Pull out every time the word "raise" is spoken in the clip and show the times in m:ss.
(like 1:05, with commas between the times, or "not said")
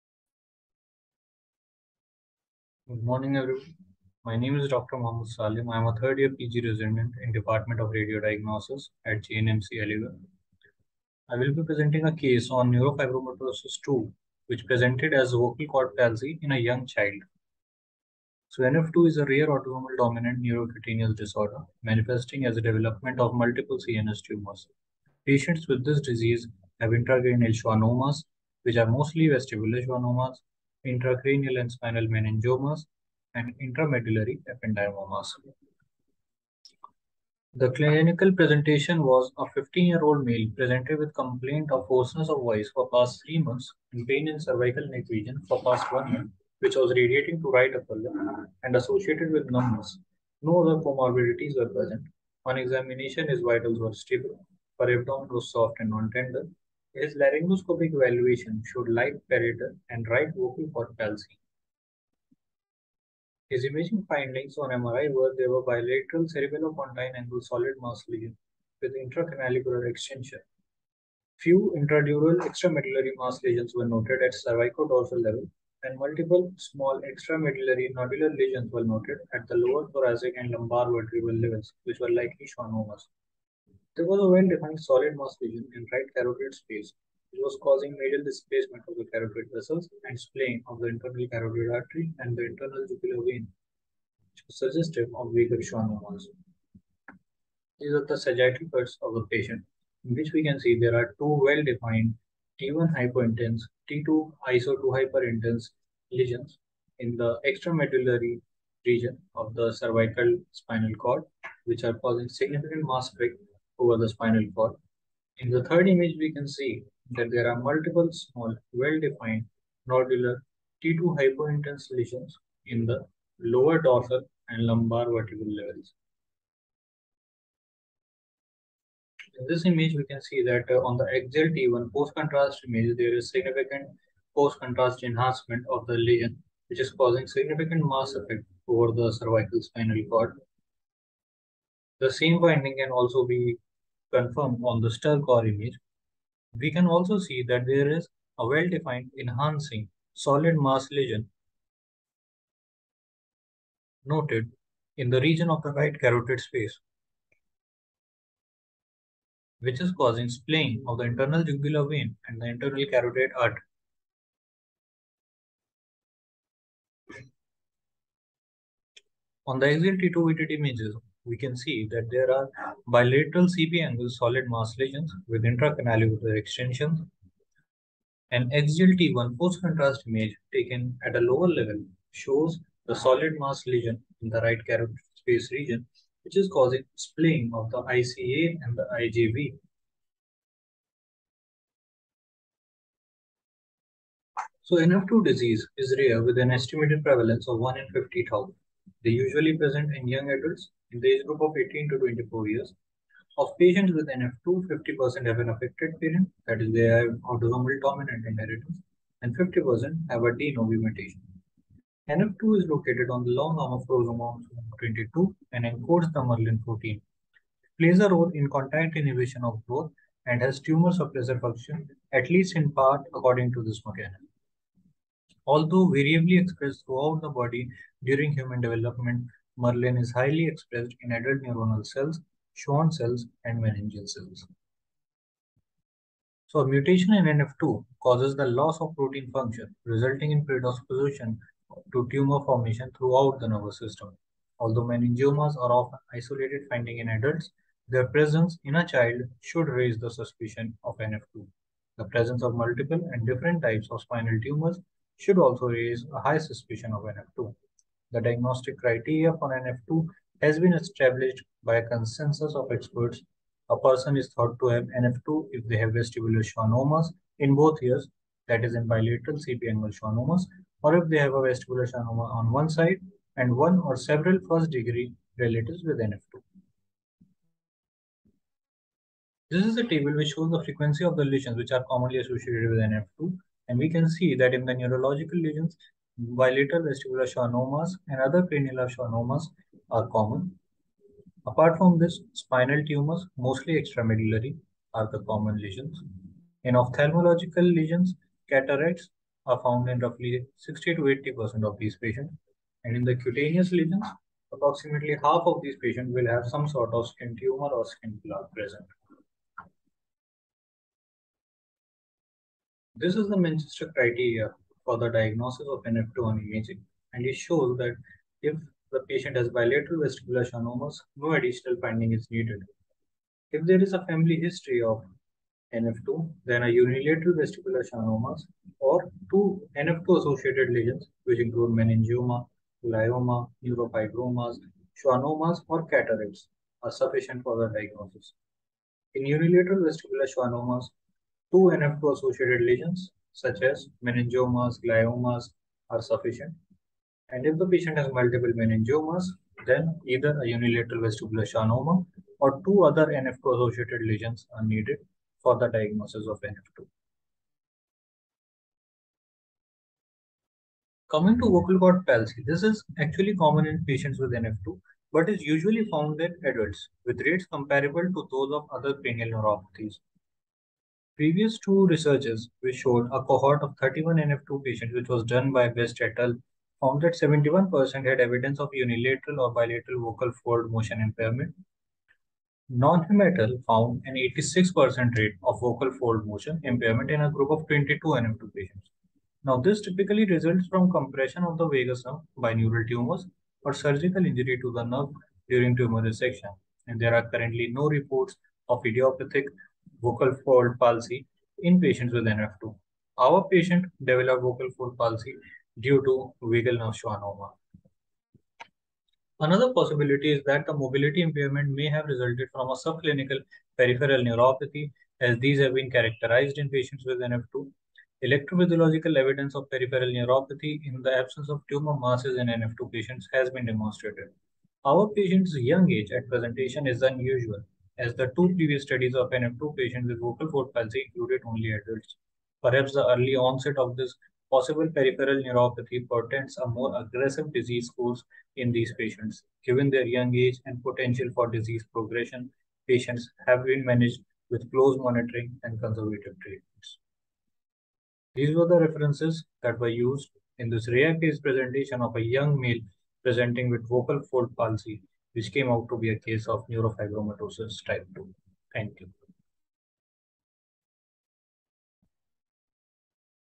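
4:09, 4:15.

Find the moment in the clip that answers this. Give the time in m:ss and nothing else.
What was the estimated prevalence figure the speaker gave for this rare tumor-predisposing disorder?
3:17.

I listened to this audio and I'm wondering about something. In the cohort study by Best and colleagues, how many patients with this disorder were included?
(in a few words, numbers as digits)
31.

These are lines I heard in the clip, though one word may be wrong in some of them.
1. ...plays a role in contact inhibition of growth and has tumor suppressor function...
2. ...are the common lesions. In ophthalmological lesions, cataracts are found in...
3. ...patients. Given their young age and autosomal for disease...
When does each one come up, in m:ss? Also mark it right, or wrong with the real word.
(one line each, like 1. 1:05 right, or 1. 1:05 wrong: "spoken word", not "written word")
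1. 3:37 right
2. 4:54 right
3. 7:18 wrong: "potential", not "autosomal".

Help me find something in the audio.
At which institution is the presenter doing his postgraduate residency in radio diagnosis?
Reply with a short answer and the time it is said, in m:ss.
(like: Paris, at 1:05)
JNMC Aligarh, at 0:09.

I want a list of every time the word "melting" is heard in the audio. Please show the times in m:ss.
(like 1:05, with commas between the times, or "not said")
not said.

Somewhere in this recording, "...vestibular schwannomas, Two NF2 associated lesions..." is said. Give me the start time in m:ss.
5:39.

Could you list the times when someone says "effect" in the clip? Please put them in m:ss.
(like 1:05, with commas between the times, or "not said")
1:53, 2:18.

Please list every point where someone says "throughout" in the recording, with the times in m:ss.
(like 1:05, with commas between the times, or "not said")
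3:46, 4:02.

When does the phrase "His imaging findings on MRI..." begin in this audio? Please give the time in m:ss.
1:03.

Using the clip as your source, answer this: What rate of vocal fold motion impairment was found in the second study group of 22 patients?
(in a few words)
86%.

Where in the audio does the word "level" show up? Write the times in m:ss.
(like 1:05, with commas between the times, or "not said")
1:15, 1:21, 2:05, 3:01.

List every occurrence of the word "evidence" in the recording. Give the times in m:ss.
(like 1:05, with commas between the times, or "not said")
6:18, 6:59.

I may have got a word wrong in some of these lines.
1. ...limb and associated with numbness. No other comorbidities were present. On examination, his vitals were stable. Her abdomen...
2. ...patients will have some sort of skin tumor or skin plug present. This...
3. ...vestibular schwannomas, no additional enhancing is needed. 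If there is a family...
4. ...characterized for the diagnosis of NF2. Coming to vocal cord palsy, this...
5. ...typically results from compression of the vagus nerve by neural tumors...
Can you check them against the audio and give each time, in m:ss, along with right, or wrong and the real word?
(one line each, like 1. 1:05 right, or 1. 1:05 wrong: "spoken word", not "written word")
1. 0:47 right
2. 5:05 right
3. 5:20 wrong: "finding", not "enhancing"
4. 5:54 wrong: "needed", not "characterized"
5. 6:29 right.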